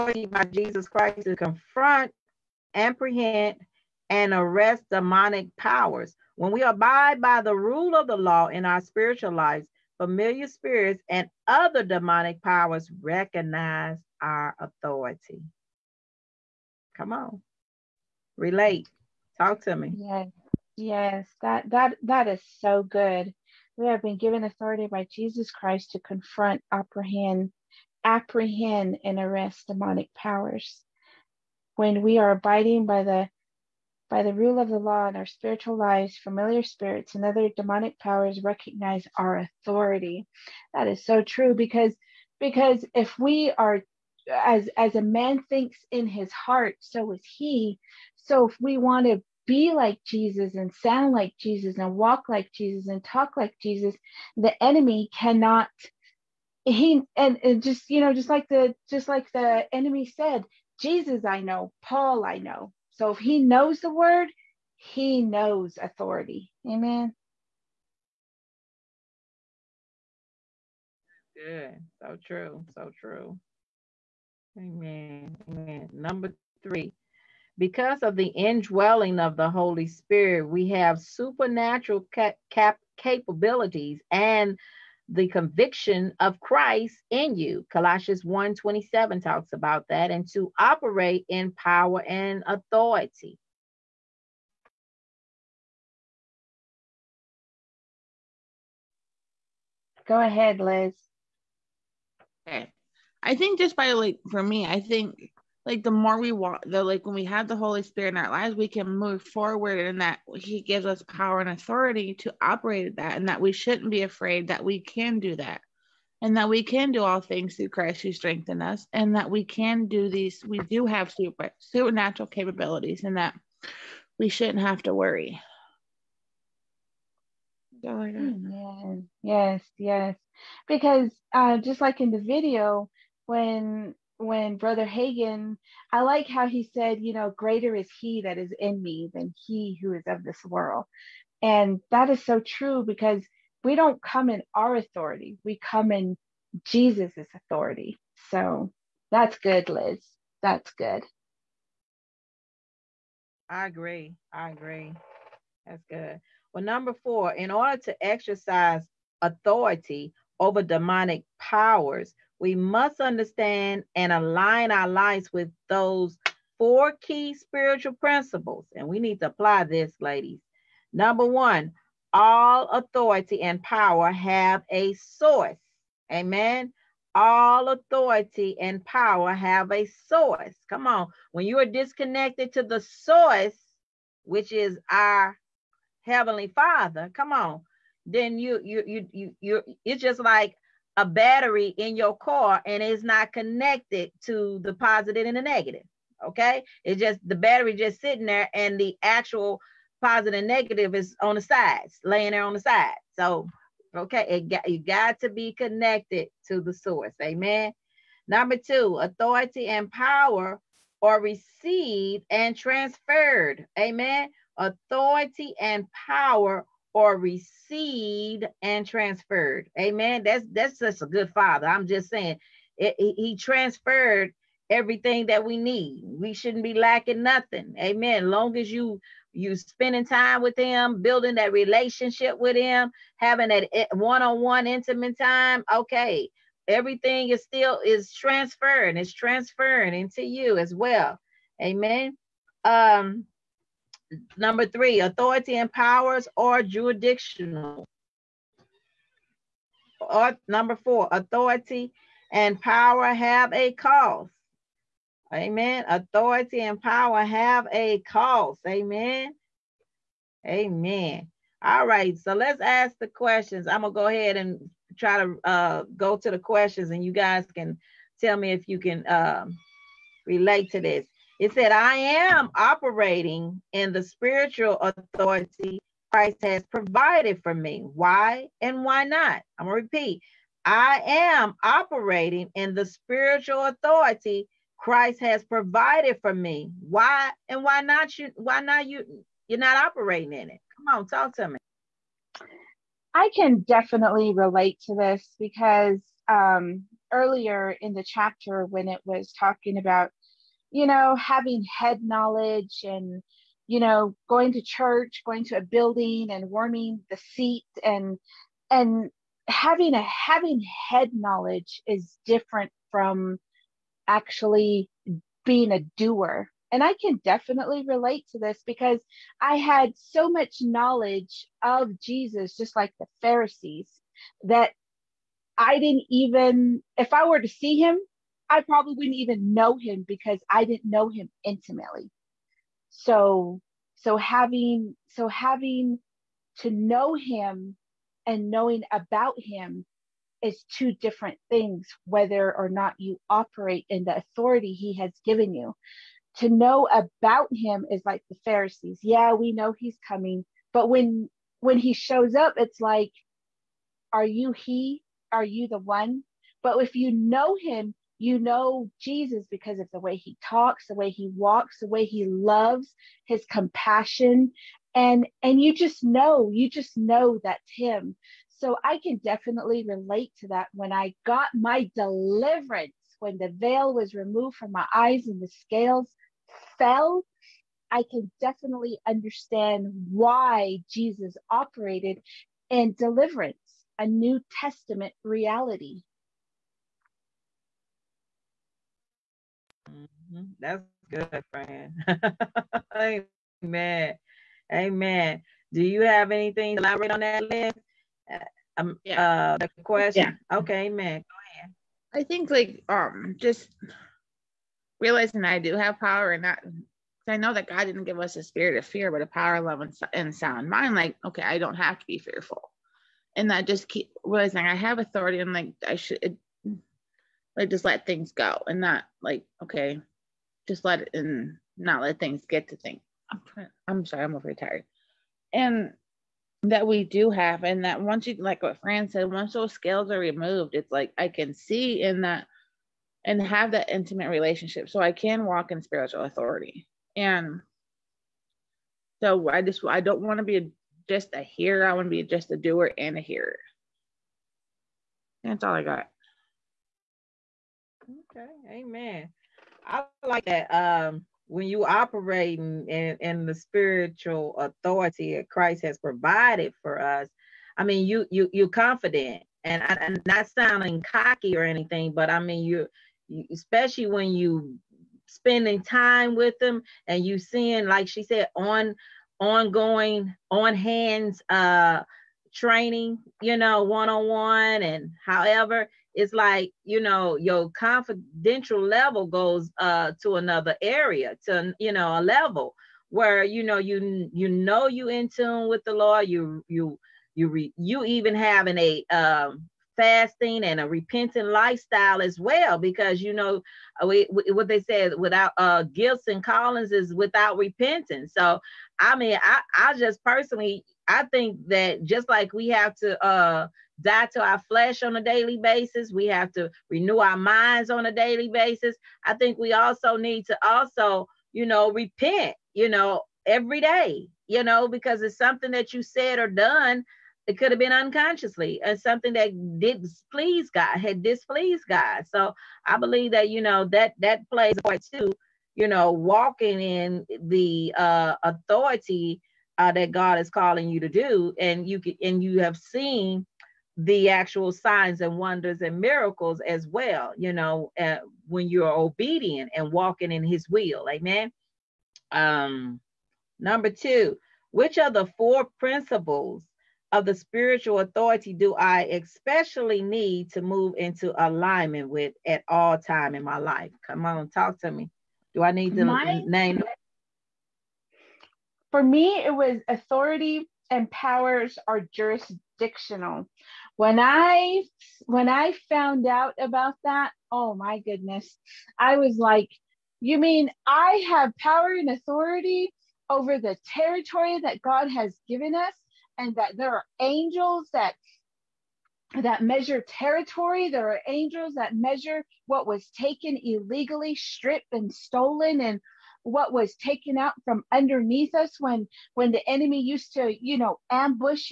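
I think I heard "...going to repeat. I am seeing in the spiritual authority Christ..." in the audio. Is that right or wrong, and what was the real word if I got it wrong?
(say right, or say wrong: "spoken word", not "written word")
wrong: "operating", not "seeing".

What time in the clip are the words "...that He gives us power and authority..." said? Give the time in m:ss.
1:50.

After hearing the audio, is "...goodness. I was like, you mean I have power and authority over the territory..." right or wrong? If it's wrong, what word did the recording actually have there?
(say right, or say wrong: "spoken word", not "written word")
right.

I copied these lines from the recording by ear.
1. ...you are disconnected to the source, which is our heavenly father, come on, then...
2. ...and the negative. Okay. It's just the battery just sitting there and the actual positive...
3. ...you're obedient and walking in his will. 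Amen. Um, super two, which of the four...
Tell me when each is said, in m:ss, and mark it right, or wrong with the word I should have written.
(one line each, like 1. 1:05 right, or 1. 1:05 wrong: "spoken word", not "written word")
1. 3:01 right
2. 3:15 right
3. 8:58 wrong: "number", not "super".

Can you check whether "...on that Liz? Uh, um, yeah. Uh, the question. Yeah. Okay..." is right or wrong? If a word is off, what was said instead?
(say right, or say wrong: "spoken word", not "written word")
right.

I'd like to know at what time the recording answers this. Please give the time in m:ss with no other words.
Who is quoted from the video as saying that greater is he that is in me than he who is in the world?
2:14.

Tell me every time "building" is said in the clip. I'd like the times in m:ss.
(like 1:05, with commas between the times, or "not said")
3:51, 5:05.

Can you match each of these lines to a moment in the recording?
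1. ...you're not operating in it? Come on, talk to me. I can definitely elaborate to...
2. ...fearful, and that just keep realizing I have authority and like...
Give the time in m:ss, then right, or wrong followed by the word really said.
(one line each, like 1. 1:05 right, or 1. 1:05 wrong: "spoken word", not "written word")
1. 4:49 wrong: "relate", not "elaborate"
2. 6:52 right.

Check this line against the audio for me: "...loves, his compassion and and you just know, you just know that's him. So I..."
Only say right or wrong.
right.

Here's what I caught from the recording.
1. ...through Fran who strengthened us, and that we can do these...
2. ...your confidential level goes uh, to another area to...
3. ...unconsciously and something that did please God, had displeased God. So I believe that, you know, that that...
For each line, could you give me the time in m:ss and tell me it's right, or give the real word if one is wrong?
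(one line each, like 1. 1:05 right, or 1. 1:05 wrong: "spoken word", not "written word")
1. 1:57 wrong: "Christ", not "Fran"
2. 7:57 right
3. 8:37 right.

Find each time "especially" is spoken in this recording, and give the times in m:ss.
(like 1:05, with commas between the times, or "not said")
7:43, 9:09.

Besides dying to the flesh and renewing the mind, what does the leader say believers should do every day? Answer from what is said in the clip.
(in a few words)
Repent.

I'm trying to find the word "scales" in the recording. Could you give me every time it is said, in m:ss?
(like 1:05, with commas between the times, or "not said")
6:15, 7:09.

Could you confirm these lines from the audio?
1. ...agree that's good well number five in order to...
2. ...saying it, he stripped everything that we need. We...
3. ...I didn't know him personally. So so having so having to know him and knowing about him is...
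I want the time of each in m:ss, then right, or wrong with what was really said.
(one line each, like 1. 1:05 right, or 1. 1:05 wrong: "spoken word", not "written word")
1. 2:34 wrong: "four", not "five"
2. 3:42 wrong: "transferred", not "stripped"
3. 5:30 wrong: "intimately", not "personally".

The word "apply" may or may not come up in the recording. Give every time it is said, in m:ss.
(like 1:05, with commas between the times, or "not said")
2:49.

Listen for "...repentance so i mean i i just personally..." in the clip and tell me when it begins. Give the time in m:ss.
8:17.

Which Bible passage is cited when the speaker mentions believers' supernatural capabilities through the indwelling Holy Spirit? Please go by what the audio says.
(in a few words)
Colossians 1:27.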